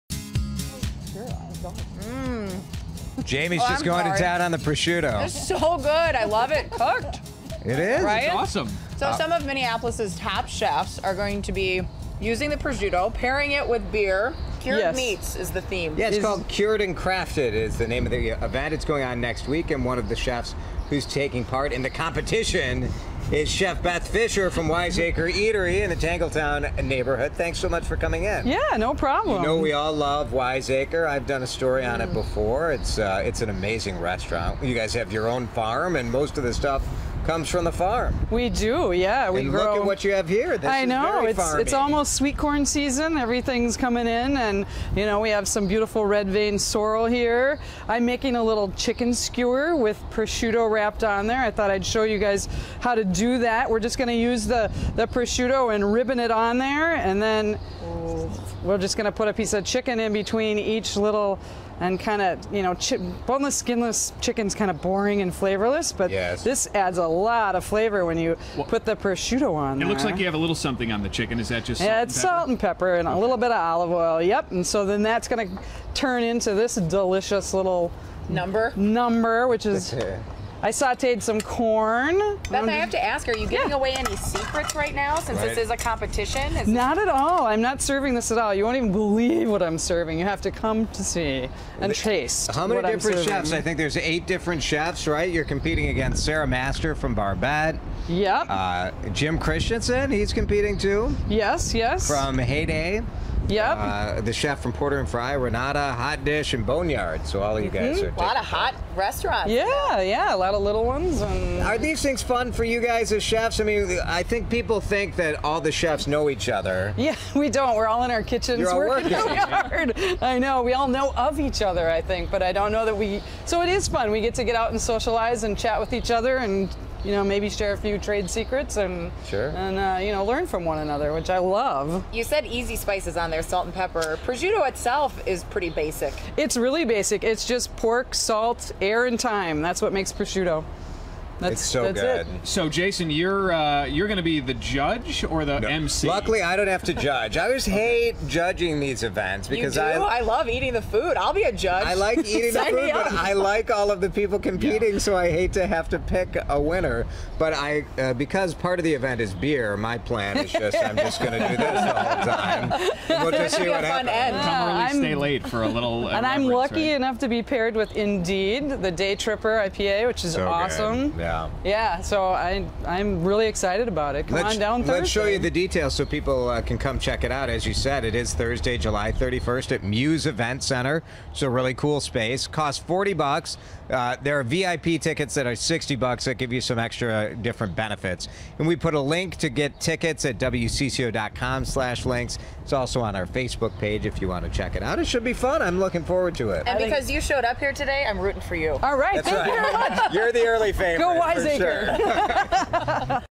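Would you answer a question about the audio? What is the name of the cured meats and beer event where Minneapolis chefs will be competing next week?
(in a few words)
Cured and Crafted.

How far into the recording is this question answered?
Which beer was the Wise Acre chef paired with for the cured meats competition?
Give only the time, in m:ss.
2:48.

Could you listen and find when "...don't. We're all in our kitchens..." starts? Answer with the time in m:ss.
1:57.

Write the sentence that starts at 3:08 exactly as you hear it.
And we put a link to get tickets at wcco.com/links.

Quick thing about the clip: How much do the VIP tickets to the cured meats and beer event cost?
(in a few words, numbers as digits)
$60.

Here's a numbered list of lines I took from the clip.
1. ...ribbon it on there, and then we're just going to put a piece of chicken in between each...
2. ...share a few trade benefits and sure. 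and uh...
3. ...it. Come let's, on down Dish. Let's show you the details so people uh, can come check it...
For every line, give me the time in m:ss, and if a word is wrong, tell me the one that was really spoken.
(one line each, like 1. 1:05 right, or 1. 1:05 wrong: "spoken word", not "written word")
1. 0:55 right
2. 2:07 wrong: "secrets", not "benefits"
3. 2:54 wrong: "Thursday", not "Dish".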